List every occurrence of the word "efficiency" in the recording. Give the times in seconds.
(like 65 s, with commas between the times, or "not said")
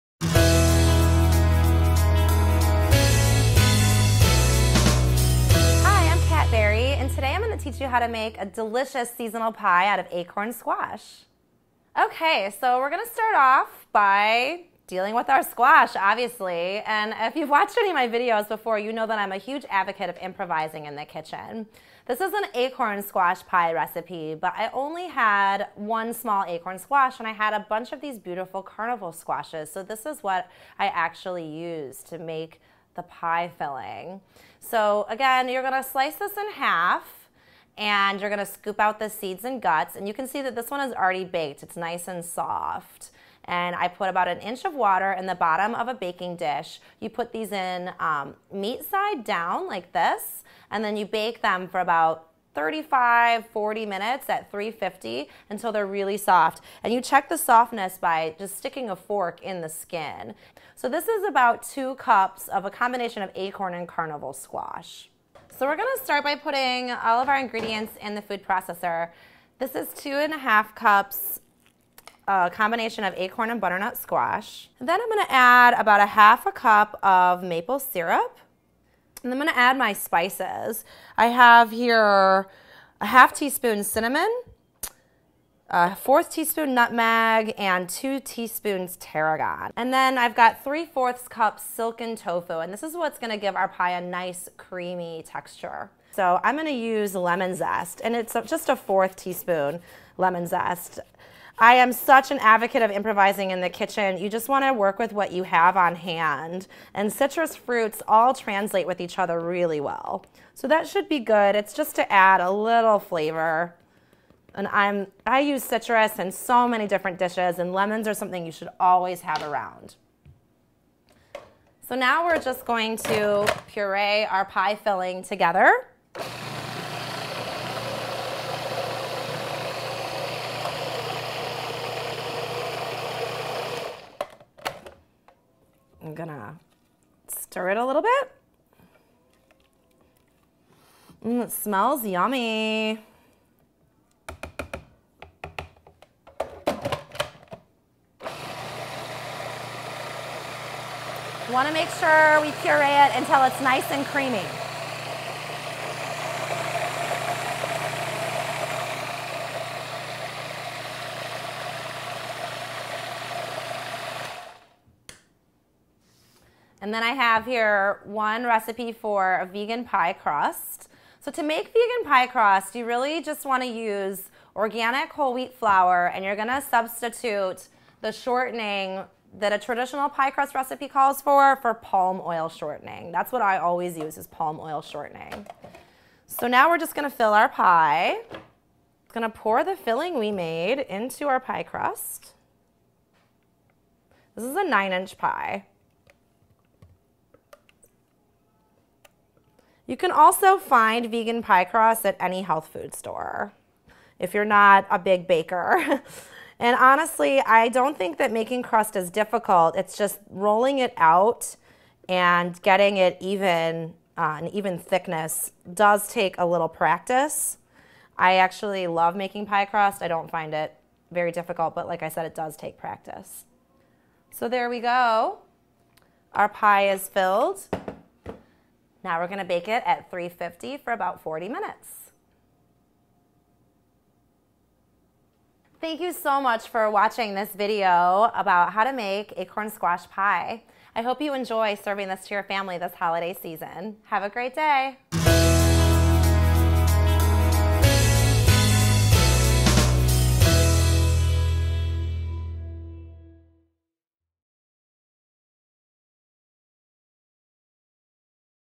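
not said.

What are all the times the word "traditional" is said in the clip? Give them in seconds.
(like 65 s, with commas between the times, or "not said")
179 s.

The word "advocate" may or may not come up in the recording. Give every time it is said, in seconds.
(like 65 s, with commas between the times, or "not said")
19 s, 102 s.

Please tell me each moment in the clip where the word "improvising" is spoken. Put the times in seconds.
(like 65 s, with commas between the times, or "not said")
20 s, 102 s.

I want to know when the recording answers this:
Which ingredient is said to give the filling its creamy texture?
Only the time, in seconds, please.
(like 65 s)
91 s.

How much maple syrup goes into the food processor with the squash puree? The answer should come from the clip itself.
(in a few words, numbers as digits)
1/2 cup.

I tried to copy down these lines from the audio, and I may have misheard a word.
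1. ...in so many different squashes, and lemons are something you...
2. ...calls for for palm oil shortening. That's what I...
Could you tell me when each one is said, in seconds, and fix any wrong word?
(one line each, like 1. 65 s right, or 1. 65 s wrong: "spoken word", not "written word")
1. 116 s wrong: "dishes", not "squashes"
2. 180 s right.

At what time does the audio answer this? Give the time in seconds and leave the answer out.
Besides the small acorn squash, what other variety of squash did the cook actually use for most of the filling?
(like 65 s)
28 s.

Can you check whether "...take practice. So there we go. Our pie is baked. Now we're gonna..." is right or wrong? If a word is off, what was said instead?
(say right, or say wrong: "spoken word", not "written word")
wrong: "filled", not "baked".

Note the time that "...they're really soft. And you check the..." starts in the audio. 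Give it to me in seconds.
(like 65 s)
55 s.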